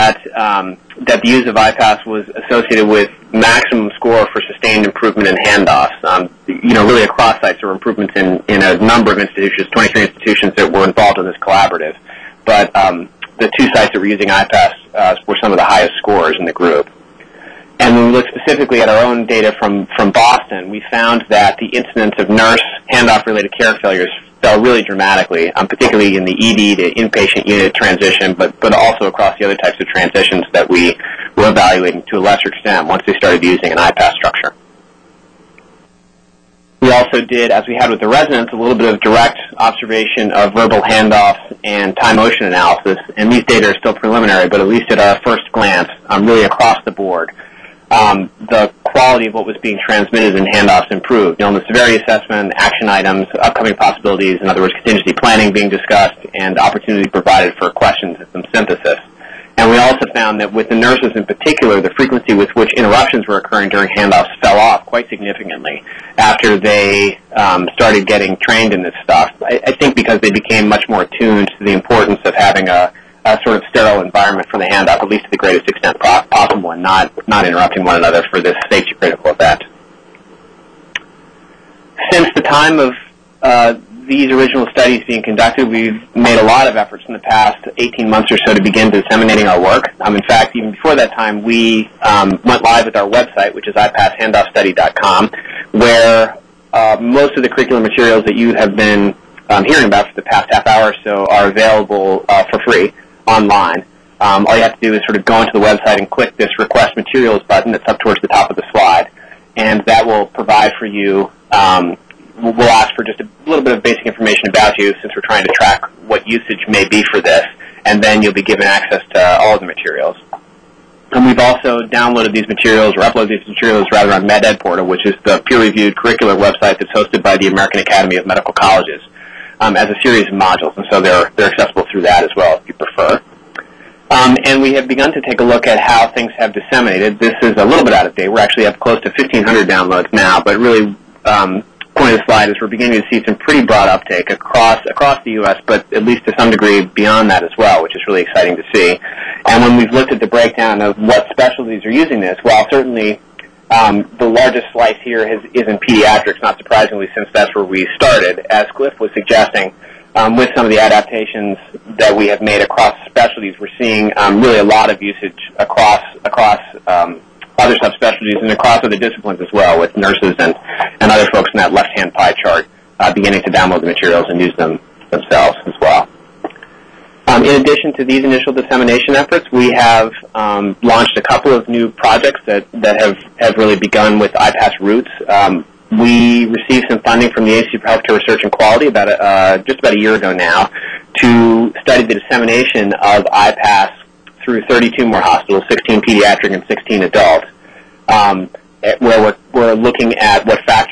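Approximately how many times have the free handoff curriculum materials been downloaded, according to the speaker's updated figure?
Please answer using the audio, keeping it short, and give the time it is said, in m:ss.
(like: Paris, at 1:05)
1,500, at 2:19.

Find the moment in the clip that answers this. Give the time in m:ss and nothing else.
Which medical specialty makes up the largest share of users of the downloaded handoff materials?
2:35.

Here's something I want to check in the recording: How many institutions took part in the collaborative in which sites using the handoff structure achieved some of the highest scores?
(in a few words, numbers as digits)
23.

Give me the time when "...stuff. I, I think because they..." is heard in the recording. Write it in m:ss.
1:09.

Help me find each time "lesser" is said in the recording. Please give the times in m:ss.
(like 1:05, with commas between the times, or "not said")
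0:32.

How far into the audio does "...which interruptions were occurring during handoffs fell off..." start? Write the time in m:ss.
1:02.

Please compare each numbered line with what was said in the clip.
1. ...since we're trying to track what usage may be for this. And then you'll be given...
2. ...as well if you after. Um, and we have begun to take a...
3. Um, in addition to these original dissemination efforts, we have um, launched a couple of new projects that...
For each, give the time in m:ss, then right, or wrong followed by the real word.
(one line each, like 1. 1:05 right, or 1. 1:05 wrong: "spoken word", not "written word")
1. 1:55 right
2. 2:12 wrong: "prefer", not "after"
3. 2:57 wrong: "initial", not "original".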